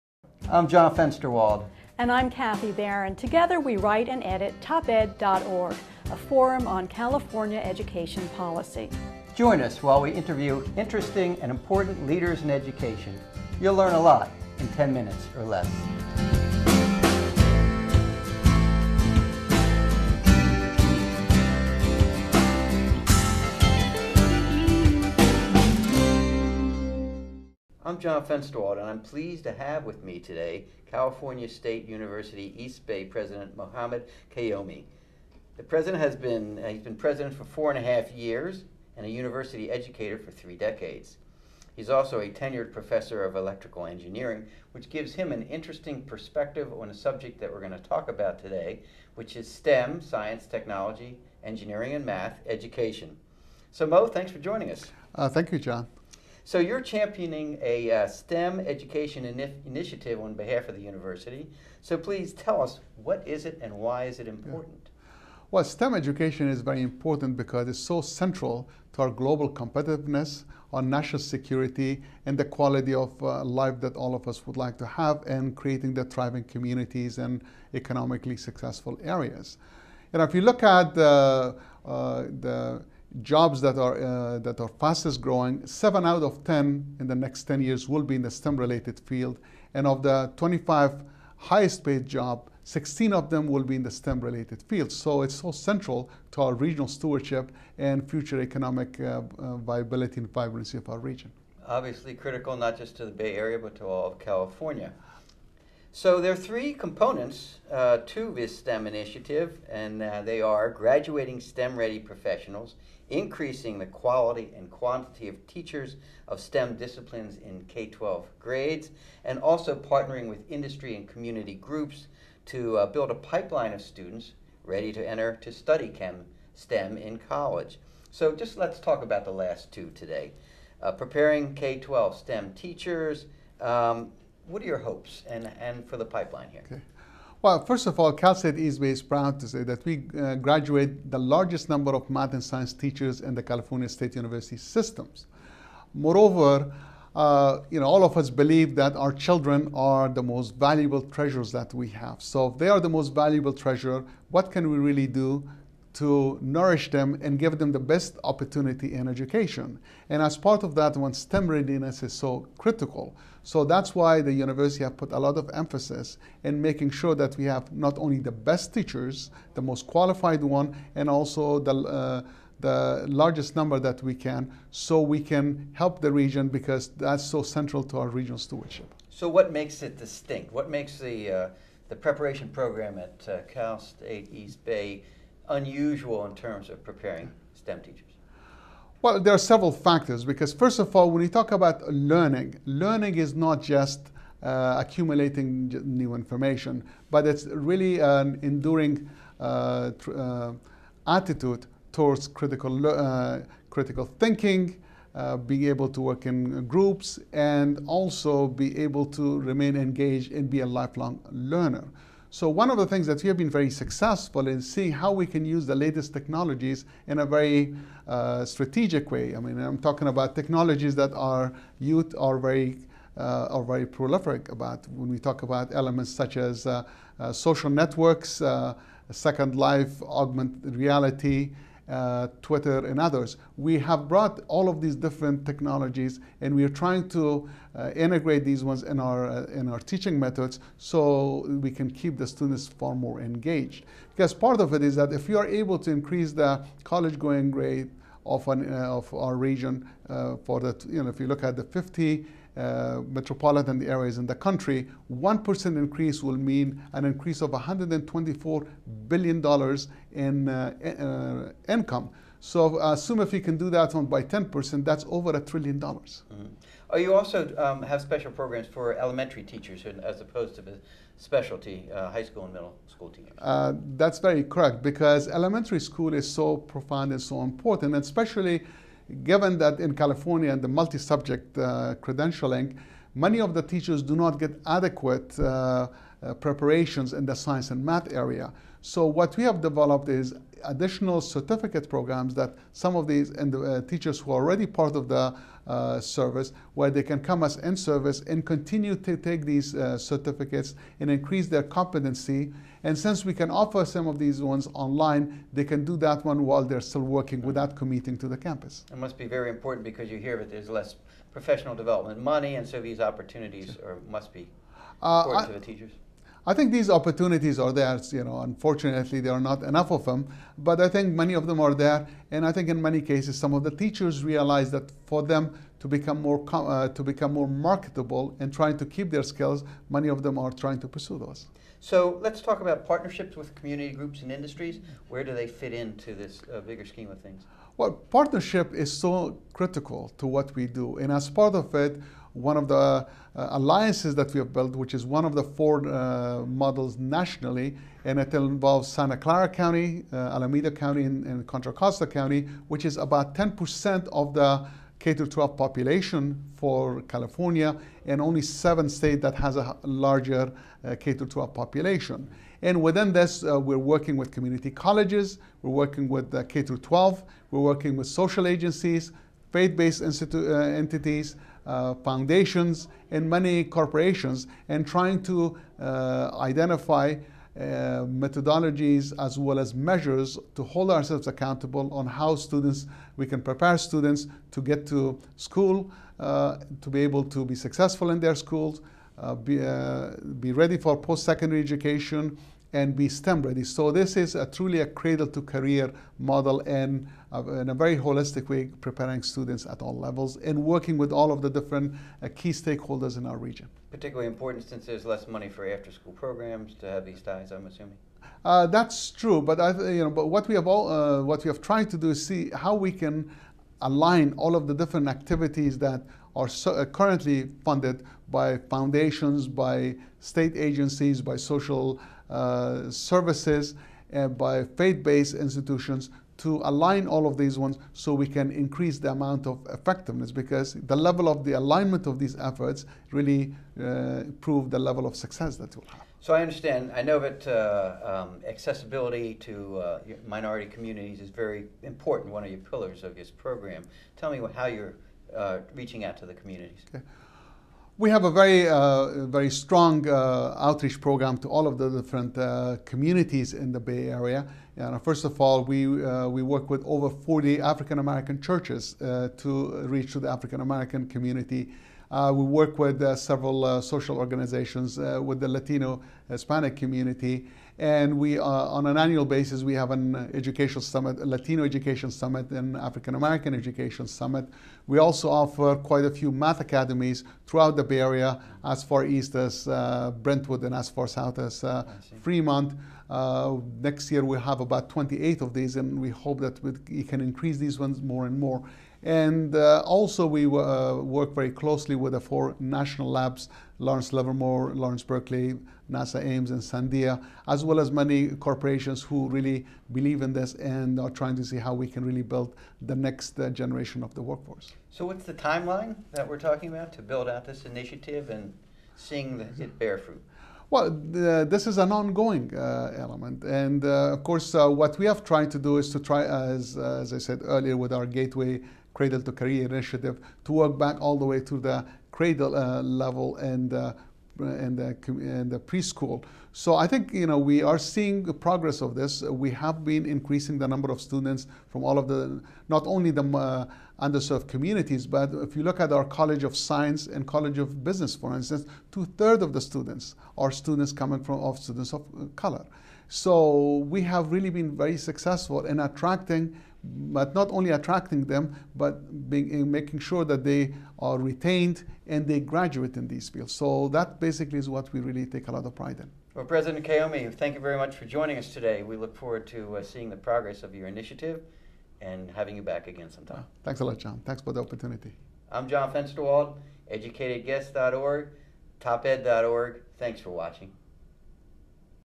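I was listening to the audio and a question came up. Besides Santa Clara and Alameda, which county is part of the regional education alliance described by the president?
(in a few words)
Contra Costa County.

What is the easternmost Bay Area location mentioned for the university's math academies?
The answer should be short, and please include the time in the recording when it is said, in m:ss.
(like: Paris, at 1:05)
Brentwood, at 8:00.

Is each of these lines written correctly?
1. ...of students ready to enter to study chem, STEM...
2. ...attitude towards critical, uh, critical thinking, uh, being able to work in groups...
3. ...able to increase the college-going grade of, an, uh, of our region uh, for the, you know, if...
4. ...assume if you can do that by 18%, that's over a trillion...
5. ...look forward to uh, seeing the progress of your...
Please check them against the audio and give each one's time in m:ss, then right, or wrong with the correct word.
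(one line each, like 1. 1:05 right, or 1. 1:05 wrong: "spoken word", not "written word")
1. 2:03 right
2. 3:21 right
3. 4:05 right
4. 4:22 wrong: "10", not "18"
5. 9:18 right.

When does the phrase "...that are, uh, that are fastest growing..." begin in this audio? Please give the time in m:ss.
1:23.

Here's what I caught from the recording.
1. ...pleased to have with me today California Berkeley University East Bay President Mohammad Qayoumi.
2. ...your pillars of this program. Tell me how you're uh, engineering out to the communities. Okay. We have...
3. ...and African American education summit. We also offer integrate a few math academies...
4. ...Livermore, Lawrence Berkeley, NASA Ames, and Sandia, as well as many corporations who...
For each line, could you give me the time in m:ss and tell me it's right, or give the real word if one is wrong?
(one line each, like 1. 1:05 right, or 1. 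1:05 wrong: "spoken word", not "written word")
1. 0:28 wrong: "State", not "Berkeley"
2. 7:22 wrong: "reaching", not "engineering"
3. 7:52 wrong: "quite", not "integrate"
4. 8:14 right.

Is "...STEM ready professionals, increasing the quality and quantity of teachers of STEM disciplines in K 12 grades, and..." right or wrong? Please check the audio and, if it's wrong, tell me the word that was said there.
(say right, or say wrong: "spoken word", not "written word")
right.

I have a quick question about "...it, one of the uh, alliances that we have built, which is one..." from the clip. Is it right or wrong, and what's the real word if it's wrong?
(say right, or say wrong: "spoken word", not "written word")
right.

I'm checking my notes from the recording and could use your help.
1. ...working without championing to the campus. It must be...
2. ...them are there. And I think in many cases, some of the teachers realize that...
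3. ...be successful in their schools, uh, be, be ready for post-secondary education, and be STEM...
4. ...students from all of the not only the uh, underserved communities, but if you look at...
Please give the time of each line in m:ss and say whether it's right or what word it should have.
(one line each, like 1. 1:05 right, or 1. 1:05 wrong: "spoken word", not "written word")
1. 5:07 wrong: "committing", not "championing"
2. 5:21 right
3. 6:27 right
4. 8:50 right.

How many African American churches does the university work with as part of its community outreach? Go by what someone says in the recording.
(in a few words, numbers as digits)
40.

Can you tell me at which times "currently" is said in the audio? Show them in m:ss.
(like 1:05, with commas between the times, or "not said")
6:56.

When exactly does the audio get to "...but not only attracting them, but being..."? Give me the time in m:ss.
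9:06.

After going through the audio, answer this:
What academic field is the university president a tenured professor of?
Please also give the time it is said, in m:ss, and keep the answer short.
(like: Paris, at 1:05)
Electrical engineering, at 0:43.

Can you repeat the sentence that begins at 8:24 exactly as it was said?
So, what's the timeline that we're talking about to build out this initiative and seeing the, it bear fruit?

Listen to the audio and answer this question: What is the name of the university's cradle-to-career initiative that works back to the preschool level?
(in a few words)
Gateway.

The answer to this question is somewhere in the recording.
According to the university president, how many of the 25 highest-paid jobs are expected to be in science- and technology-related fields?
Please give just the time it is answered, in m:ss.
1:32.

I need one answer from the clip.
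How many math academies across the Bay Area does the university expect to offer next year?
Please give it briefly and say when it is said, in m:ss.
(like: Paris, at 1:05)
28, at 8:04.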